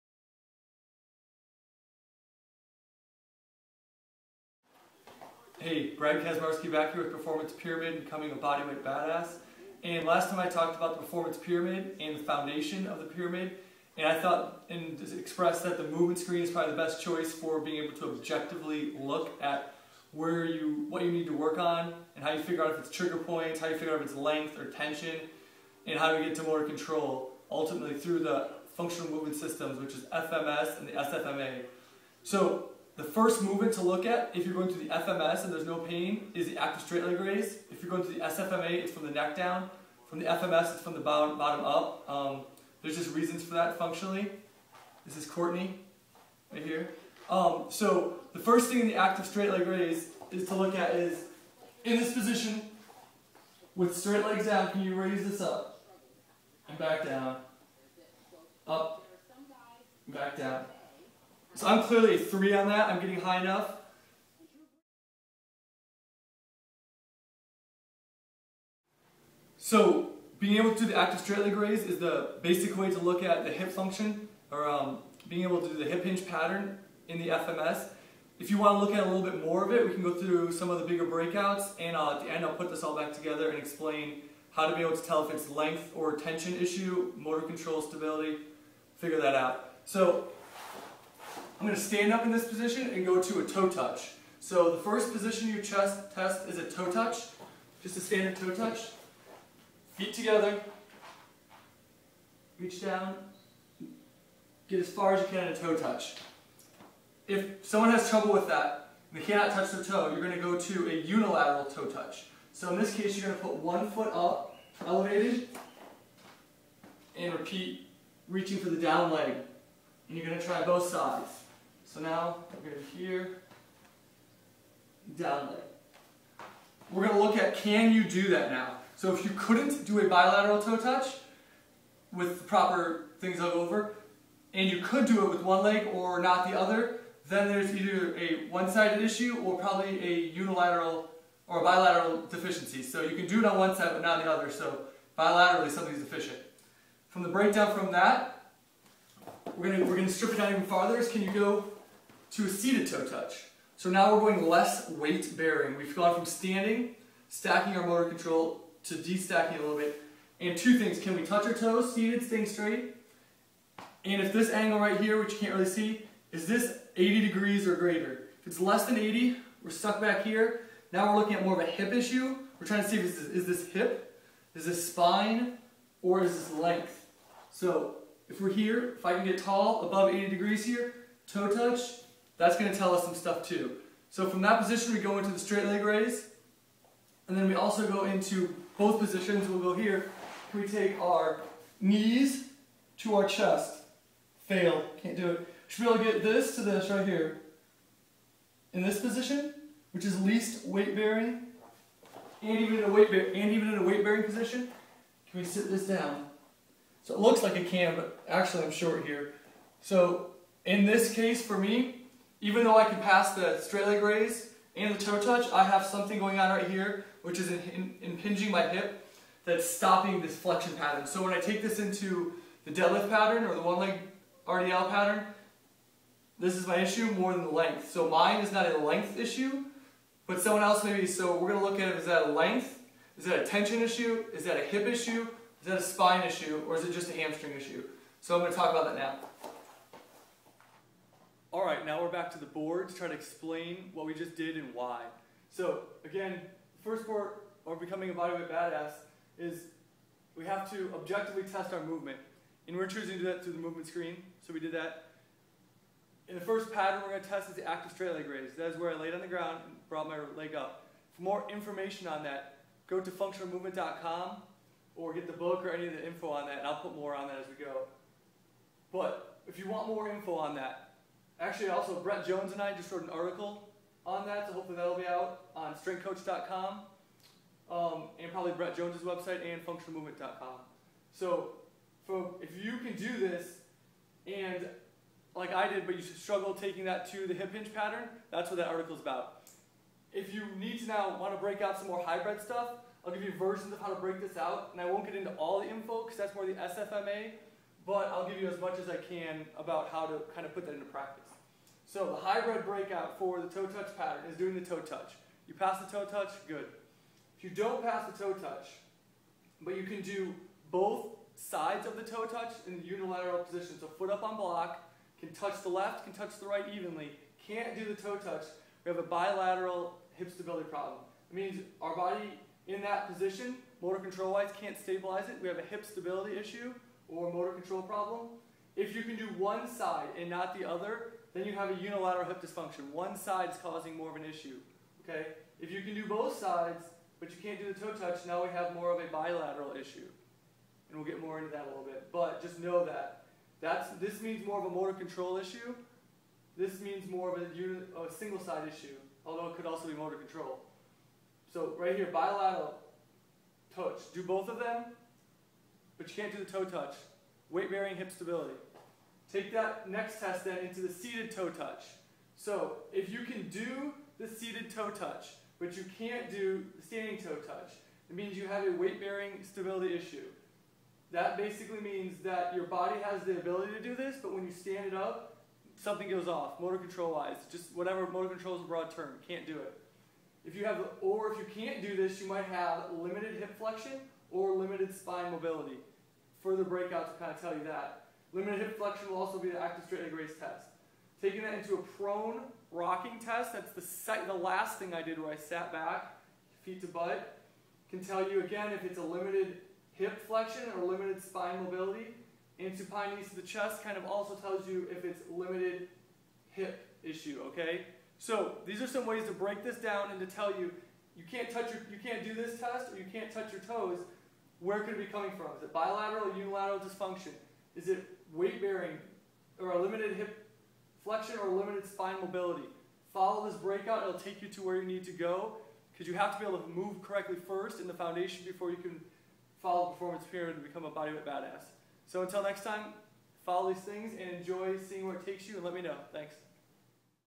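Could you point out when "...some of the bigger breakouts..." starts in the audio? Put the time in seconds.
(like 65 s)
80 s.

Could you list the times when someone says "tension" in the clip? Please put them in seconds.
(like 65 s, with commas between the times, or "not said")
24 s, 86 s, 233 s.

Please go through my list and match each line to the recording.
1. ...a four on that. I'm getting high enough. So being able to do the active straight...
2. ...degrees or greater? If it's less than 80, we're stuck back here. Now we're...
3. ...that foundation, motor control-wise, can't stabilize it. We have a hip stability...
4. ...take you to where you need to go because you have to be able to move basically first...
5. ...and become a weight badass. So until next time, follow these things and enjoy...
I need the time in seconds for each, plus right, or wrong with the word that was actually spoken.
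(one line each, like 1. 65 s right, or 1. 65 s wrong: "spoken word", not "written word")
1. 62 s wrong: "three", not "four"
2. 167 s right
3. 322 s wrong: "position", not "foundation"
4. 424 s wrong: "correctly", not "basically"
5. 430 s wrong: "bodyweight", not "weight".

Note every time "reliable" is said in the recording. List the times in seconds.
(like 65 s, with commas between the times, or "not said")
not said.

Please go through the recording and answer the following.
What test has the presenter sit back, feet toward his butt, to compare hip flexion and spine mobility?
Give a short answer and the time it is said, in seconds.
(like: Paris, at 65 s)
prone rocking test, at 391 s.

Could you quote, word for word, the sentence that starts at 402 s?
And supine knees to the chest kind of also tells you if it's limited hip issue, okay?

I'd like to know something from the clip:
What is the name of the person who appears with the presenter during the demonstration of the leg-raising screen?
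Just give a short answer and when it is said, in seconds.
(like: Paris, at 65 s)
Courtney, at 45 s.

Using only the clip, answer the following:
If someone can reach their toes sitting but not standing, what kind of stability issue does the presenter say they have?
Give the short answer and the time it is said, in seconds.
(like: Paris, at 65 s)
Weight bearing stability, at 368 s.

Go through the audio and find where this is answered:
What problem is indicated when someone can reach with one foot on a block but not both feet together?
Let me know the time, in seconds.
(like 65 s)
331 s.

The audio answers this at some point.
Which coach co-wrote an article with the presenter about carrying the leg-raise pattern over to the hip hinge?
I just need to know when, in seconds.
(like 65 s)
271 s.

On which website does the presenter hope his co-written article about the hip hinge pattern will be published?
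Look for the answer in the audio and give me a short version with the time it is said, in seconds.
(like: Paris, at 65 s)
strengthcoach.com, at 275 s.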